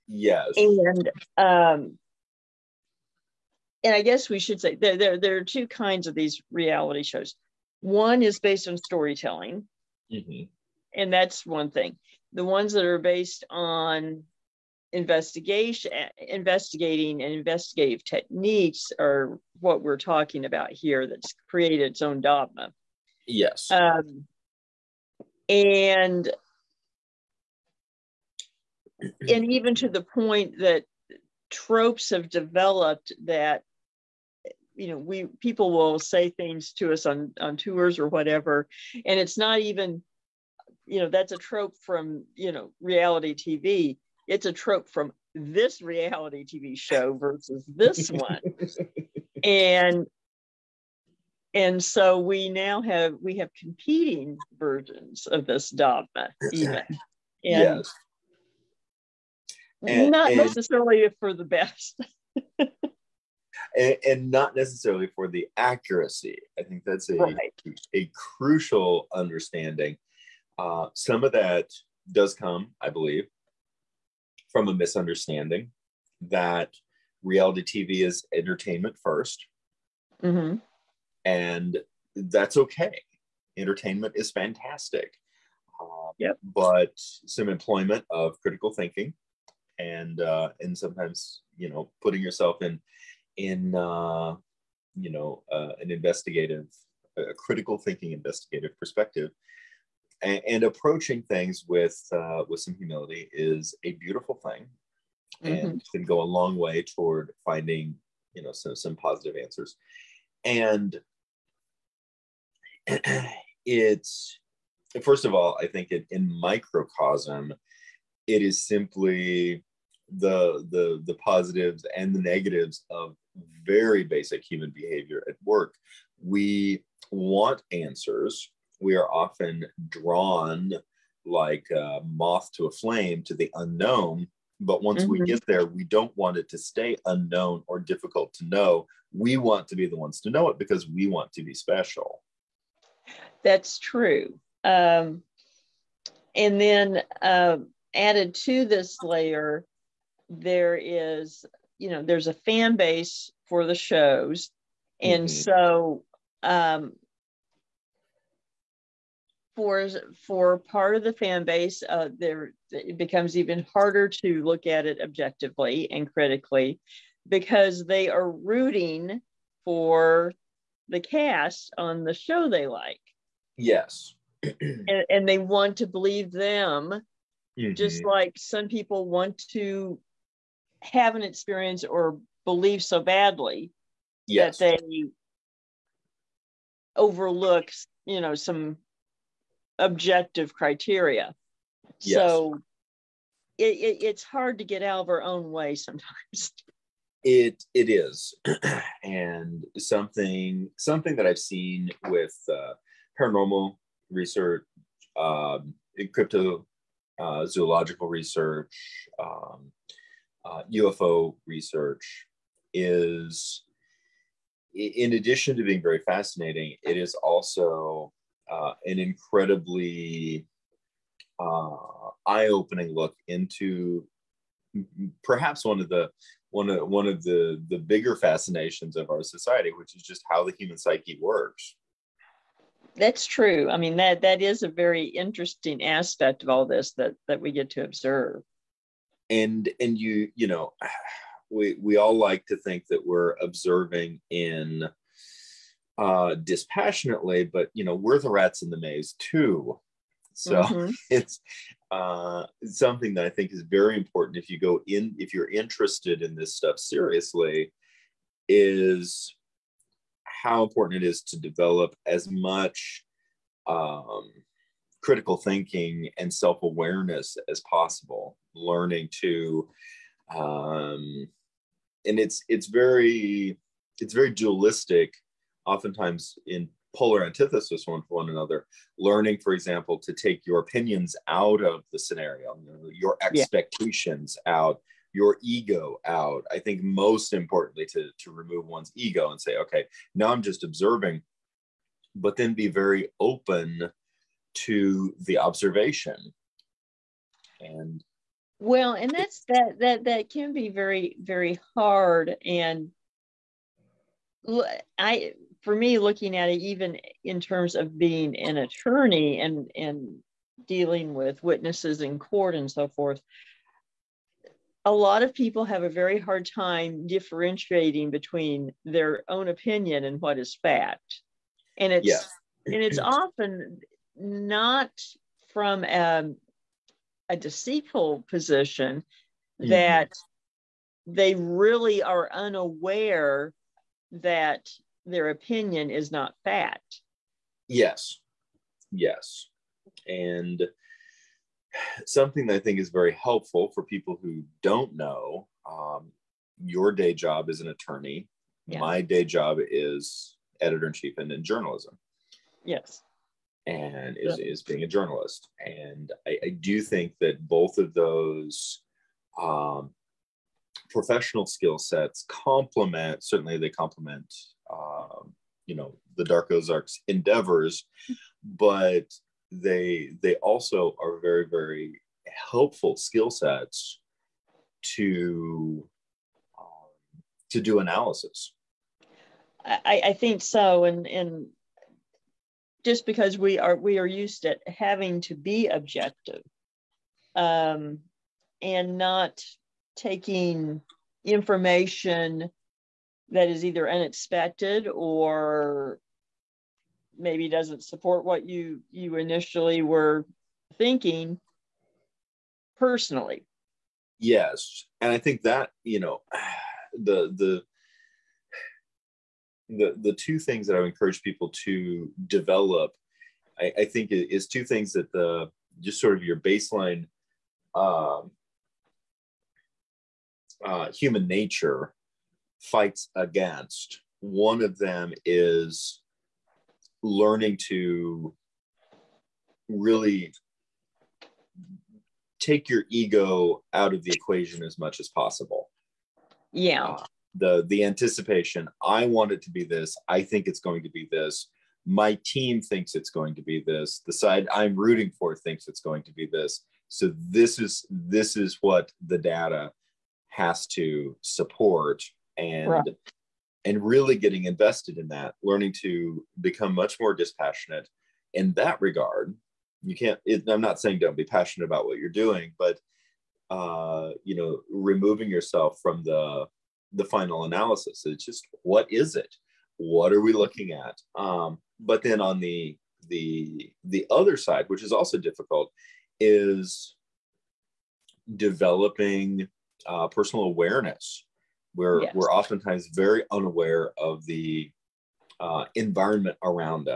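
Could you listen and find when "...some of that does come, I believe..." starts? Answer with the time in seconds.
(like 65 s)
70 s.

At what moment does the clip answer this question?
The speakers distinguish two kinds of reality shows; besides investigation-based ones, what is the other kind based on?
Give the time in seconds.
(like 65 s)
8 s.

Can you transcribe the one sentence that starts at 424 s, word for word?
One of them is learning to really take your ego out of the equation as much as possible.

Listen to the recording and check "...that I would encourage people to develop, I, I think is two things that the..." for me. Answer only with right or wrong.
right.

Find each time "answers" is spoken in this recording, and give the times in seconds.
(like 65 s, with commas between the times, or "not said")
109 s, 127 s.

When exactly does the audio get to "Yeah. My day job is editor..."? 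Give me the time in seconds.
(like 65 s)
348 s.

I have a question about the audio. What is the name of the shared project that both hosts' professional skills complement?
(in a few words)
Dark Ozarks.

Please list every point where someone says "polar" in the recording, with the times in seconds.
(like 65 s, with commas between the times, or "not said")
276 s.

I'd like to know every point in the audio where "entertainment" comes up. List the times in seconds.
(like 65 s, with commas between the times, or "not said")
78 s, 83 s.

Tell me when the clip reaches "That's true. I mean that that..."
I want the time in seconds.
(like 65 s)
232 s.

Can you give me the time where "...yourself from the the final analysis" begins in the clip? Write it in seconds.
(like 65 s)
465 s.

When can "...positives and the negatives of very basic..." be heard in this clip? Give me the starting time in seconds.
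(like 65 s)
121 s.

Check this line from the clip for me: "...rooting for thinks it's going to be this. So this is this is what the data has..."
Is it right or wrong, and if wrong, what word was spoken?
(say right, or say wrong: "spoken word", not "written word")
right.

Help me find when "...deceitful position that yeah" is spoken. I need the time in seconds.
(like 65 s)
327 s.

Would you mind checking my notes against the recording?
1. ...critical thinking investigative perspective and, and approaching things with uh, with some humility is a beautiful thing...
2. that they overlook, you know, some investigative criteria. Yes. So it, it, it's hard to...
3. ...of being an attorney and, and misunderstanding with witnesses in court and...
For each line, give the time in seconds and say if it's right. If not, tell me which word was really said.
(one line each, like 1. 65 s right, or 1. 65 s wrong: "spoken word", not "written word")
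1. 97 s right
2. 184 s wrong: "objective", not "investigative"
3. 307 s wrong: "dealing", not "misunderstanding".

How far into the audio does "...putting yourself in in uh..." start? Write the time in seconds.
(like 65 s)
92 s.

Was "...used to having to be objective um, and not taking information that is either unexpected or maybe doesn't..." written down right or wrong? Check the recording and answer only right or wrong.
right.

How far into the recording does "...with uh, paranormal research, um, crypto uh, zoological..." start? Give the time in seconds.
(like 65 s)
202 s.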